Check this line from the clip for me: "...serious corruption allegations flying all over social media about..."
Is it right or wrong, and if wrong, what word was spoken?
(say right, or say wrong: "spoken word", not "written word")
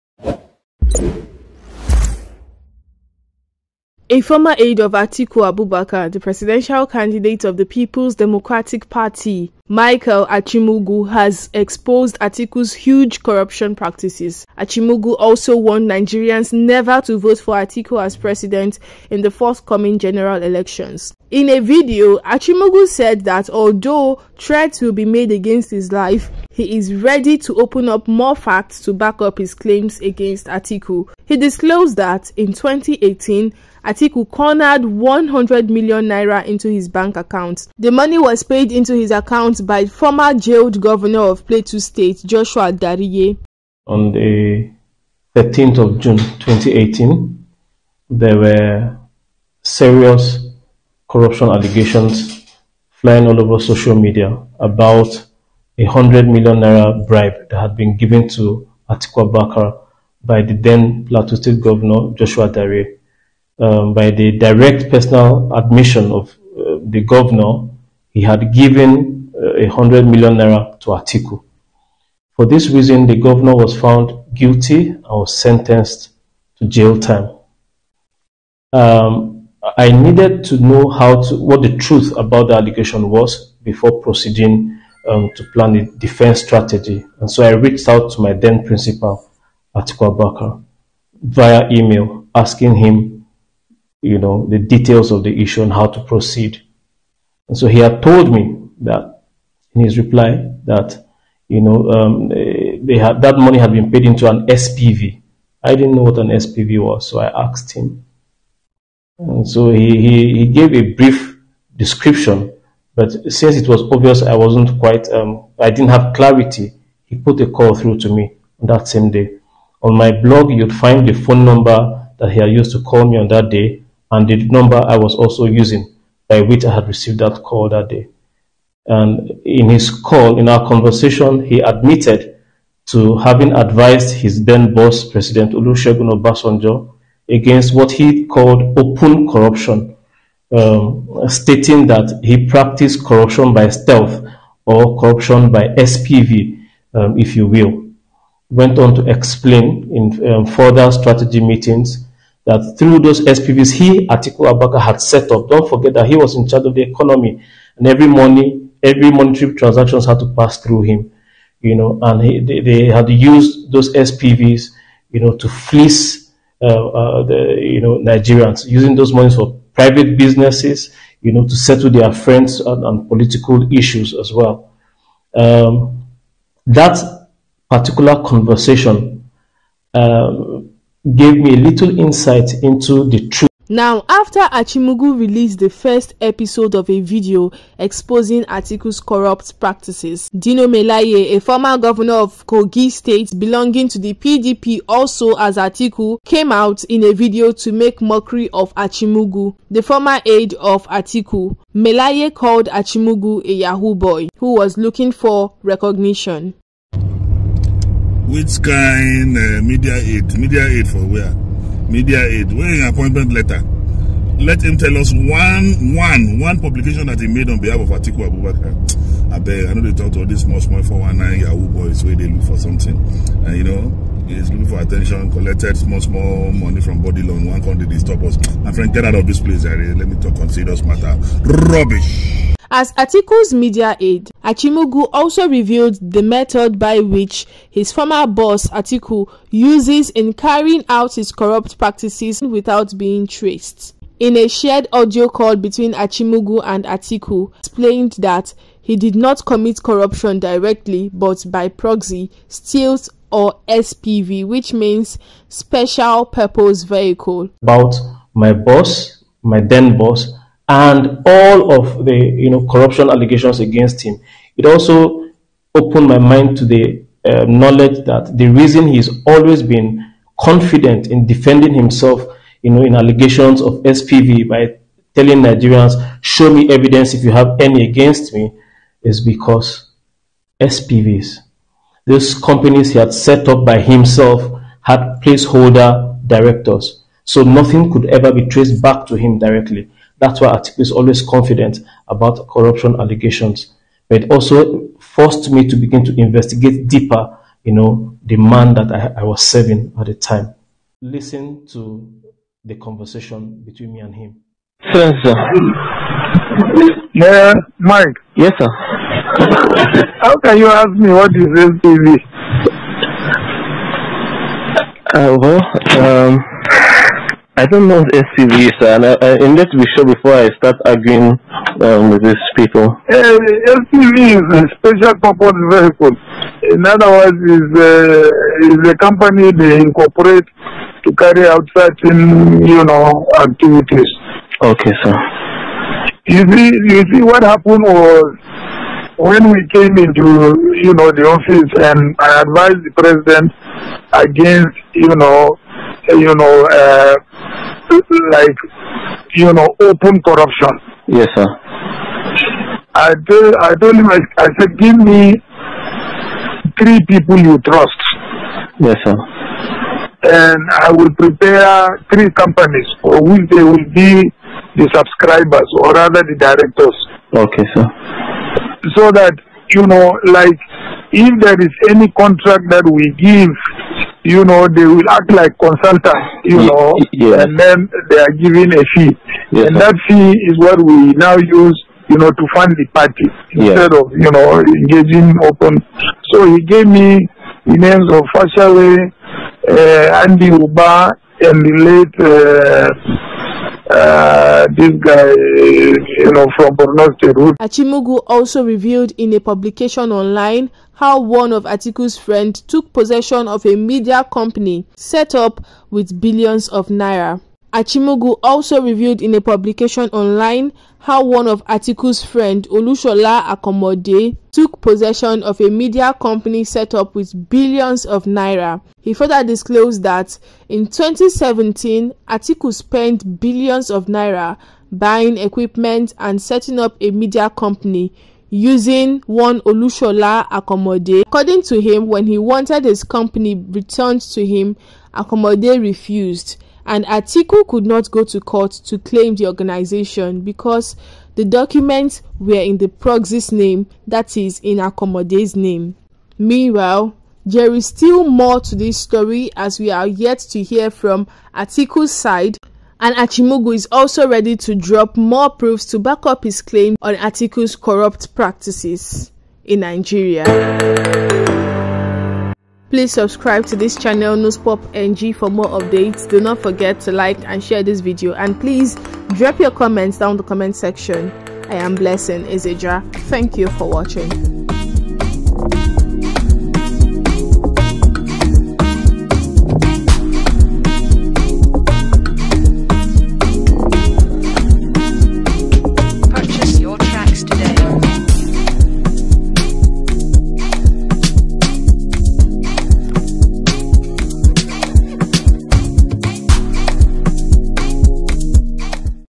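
right.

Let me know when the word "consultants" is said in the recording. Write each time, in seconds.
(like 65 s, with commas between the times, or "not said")
375 s.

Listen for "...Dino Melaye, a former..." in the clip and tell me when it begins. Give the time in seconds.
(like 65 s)
190 s.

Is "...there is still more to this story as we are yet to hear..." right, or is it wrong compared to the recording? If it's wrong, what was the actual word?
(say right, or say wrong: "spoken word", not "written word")
right.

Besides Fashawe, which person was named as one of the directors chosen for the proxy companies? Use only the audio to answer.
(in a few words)
Andy Uba.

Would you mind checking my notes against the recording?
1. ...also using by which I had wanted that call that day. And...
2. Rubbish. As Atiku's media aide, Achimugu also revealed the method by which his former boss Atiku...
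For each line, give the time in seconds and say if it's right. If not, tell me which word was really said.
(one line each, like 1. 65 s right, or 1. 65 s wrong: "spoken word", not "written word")
1. 125 s wrong: "received", not "wanted"
2. 231 s right.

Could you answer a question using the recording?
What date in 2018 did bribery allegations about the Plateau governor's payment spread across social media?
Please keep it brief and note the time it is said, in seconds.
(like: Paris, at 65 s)
13 June, at 45 s.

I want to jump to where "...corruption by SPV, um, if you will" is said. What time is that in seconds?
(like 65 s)
144 s.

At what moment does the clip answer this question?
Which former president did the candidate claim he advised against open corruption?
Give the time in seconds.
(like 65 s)
135 s.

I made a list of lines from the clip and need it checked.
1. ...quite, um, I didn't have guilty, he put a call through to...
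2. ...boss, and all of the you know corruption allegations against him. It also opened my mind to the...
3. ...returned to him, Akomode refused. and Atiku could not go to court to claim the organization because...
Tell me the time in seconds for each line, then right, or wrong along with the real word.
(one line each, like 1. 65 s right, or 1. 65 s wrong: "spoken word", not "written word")
1. 114 s wrong: "clarity", not "guilty"
2. 259 s right
3. 433 s right.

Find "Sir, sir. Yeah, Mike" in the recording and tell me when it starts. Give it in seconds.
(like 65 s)
304 s.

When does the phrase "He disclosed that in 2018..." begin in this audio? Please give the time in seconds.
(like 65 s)
31 s.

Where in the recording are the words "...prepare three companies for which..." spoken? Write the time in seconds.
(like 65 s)
361 s.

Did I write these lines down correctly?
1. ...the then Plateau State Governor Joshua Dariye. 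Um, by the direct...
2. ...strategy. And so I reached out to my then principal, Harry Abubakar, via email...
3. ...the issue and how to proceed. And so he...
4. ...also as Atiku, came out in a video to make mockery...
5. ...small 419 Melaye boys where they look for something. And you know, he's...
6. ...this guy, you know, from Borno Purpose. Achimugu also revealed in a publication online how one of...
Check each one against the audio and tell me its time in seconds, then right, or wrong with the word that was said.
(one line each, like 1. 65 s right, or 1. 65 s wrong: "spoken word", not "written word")
1. 60 s right
2. 86 s wrong: "Atiku", not "Harry"
3. 95 s right
4. 194 s right
5. 220 s wrong: "Yahoo", not "Melaye"
6. 394 s wrong: "State", not "Purpose".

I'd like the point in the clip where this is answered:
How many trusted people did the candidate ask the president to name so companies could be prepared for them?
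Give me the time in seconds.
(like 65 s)
356 s.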